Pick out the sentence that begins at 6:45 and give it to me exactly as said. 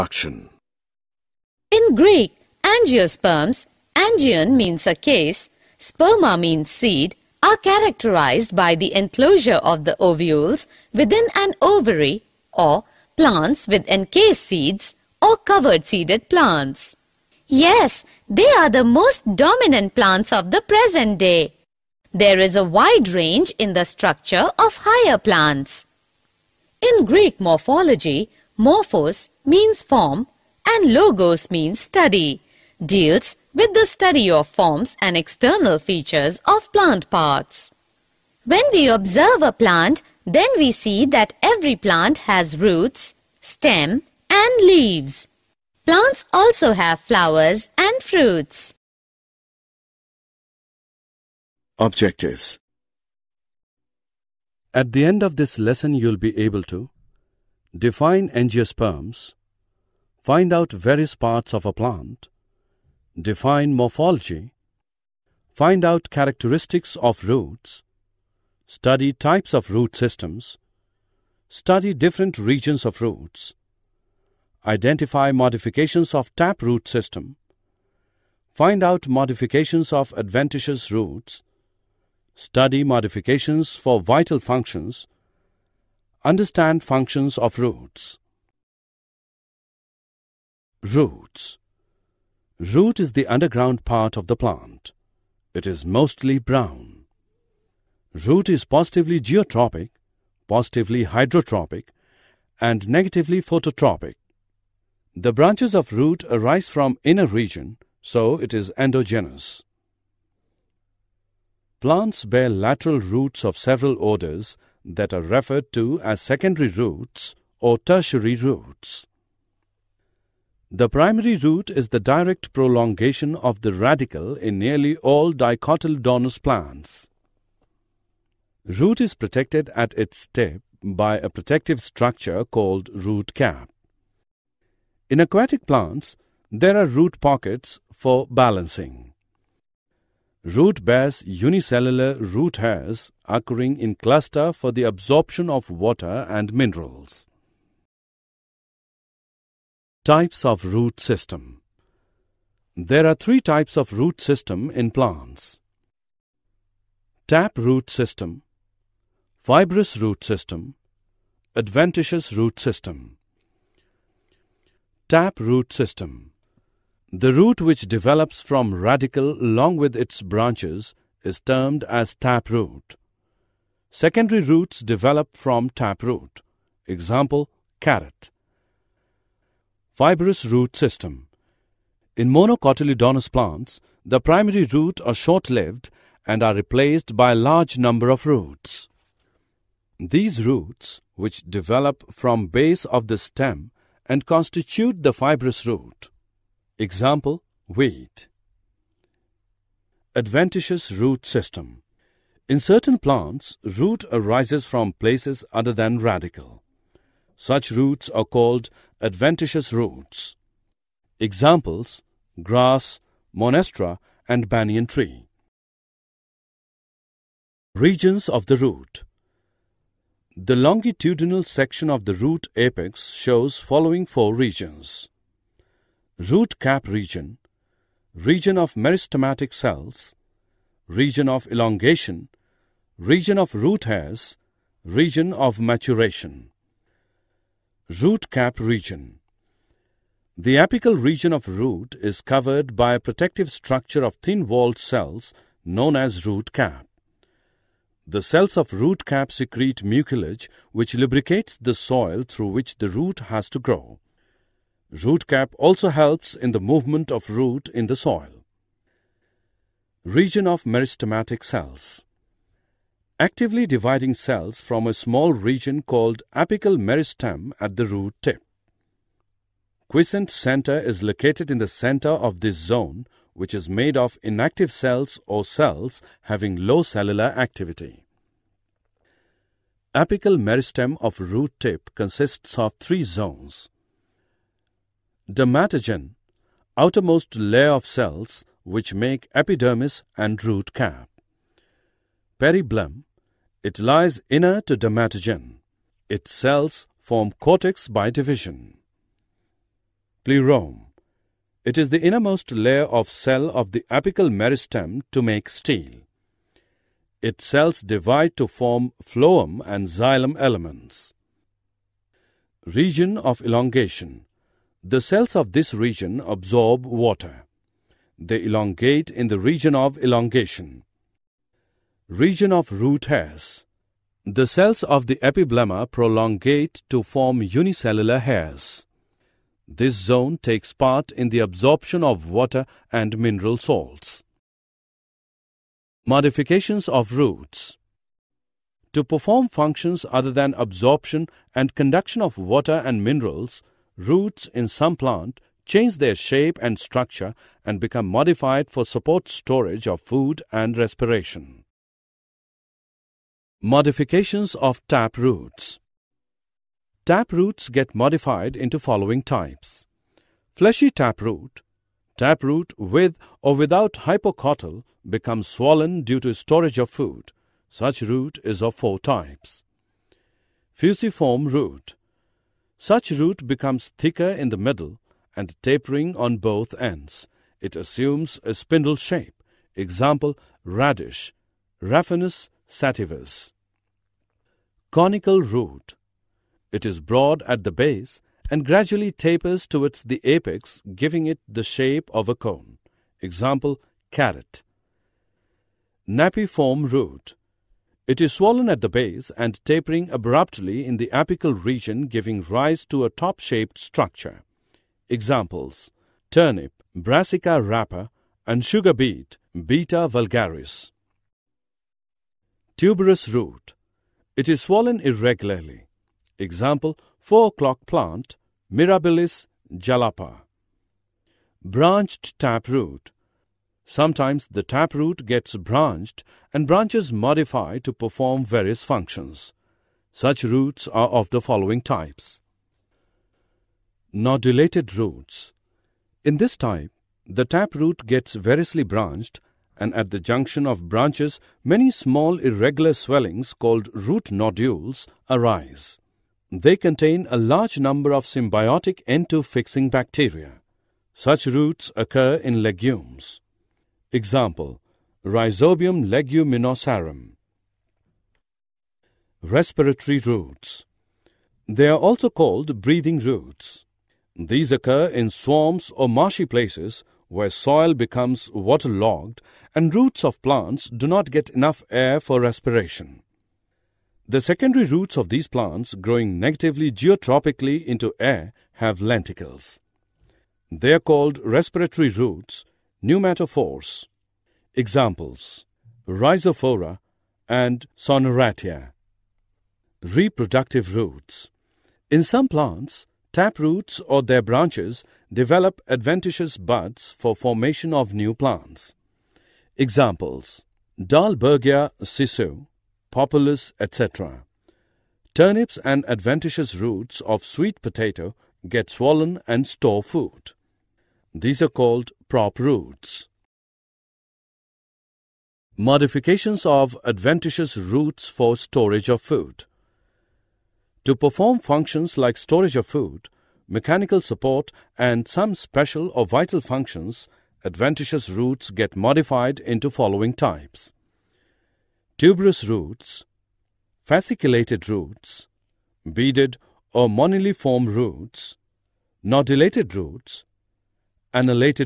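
Examples Turnip, Brassica rapa and sugar beet, Beta vulgaris.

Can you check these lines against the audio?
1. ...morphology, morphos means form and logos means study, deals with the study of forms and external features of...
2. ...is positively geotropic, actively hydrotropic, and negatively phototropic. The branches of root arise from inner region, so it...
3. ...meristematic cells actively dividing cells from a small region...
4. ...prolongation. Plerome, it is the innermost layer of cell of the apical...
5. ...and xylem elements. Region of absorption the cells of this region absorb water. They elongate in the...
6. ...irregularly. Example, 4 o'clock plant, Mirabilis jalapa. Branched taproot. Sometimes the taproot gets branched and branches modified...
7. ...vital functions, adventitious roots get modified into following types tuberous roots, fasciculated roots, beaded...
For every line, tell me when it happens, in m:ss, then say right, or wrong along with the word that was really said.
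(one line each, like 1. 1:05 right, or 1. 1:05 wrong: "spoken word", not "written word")
1. 0:27 right
2. 1:38 wrong: "positively", not "actively"
3. 4:20 right
4. 4:58 wrong: "division", not "prolongation"
5. 5:09 wrong: "elongation", not "absorption"
6. 6:54 right
7. 8:46 right.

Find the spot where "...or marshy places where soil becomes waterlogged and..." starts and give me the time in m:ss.
7:45.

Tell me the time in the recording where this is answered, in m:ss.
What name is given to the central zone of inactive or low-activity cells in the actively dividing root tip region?
4:29.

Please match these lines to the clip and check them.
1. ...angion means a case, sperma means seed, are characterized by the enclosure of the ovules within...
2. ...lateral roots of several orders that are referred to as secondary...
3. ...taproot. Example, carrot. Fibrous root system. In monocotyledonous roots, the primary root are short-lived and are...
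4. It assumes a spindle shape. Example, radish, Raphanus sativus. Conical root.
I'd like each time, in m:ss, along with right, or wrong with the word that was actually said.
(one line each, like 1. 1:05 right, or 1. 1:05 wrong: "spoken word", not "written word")
1. 0:03 right
2. 1:52 right
3. 2:55 wrong: "plants", not "roots"
4. 6:17 right.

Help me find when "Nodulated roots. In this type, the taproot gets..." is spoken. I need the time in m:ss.
7:14.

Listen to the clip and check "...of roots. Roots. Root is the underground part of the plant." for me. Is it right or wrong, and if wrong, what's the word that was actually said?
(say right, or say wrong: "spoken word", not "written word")
right.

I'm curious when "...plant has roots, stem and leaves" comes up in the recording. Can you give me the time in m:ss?
0:41.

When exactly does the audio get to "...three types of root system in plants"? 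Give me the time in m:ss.
2:33.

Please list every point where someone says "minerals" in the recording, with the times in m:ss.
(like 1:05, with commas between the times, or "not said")
2:26, 5:33, 5:43.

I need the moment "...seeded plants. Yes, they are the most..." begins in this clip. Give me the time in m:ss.
0:15.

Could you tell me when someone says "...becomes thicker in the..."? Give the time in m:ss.
6:13.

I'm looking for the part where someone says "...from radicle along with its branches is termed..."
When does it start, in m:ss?
2:48.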